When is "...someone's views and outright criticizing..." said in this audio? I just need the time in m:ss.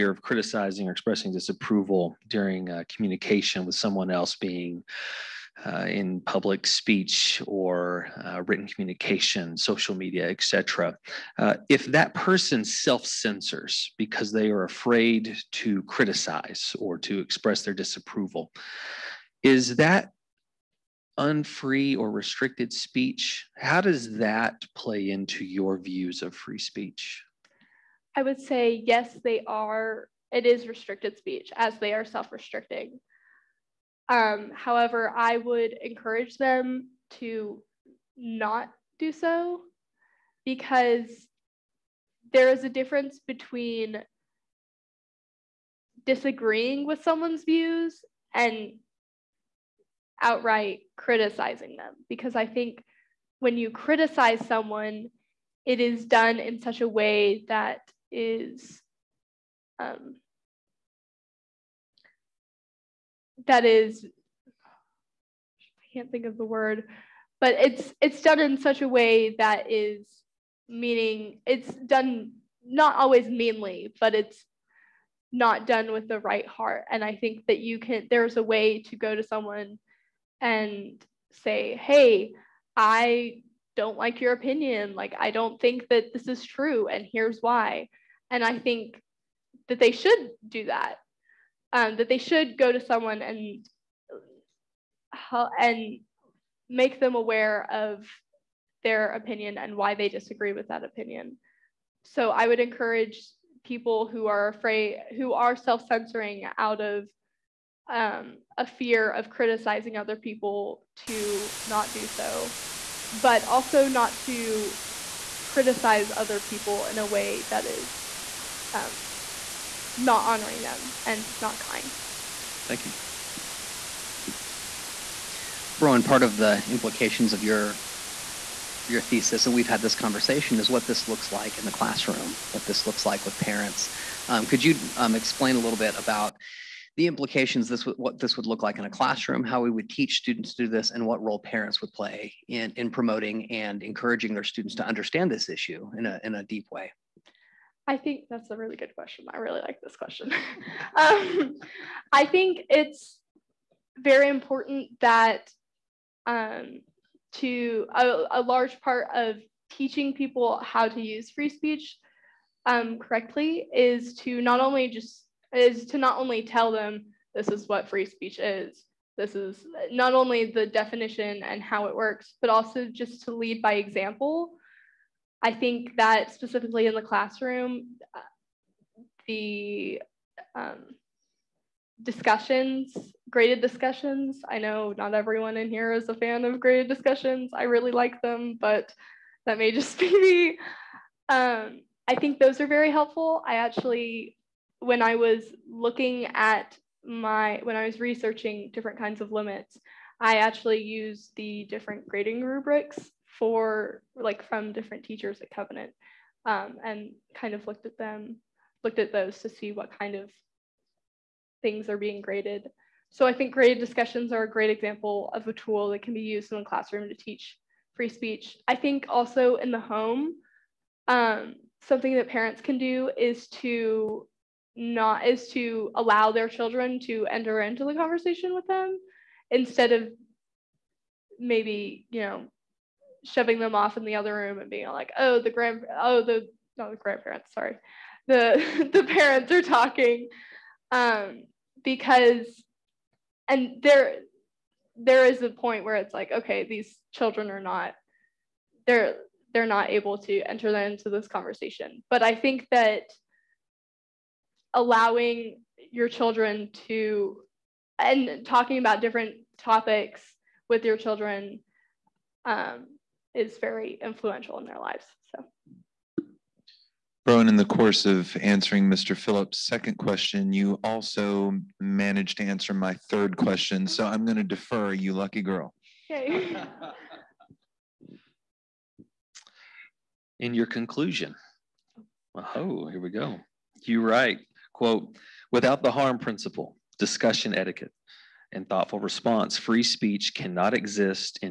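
0:47.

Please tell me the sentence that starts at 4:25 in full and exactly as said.
So, Browen, in the course of answering Mr.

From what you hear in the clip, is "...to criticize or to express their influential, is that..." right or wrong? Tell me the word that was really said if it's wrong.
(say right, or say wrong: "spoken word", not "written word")
wrong: "disapproval", not "influential".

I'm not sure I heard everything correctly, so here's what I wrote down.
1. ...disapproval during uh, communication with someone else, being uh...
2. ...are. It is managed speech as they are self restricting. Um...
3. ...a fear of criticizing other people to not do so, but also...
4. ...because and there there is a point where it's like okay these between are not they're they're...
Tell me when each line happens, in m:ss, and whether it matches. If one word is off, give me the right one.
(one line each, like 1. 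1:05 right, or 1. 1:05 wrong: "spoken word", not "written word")
1. 0:01 right
2. 0:29 wrong: "restricted", not "managed"
3. 1:48 right
4. 4:01 wrong: "children", not "between".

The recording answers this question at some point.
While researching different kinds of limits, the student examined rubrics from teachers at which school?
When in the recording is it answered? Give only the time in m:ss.
3:25.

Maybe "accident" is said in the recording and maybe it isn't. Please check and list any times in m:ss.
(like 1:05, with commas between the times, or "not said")
not said.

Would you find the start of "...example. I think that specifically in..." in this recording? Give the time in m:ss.
2:53.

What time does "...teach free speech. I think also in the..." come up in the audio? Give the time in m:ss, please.
3:37.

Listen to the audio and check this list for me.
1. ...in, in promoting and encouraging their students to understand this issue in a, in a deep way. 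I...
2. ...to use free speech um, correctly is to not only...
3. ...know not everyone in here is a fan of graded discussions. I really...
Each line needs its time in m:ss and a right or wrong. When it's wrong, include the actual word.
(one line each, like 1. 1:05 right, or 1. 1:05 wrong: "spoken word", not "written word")
1. 2:22 right
2. 2:40 right
3. 3:04 right.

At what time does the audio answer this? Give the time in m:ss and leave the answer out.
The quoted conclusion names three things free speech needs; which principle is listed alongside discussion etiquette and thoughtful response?
4:45.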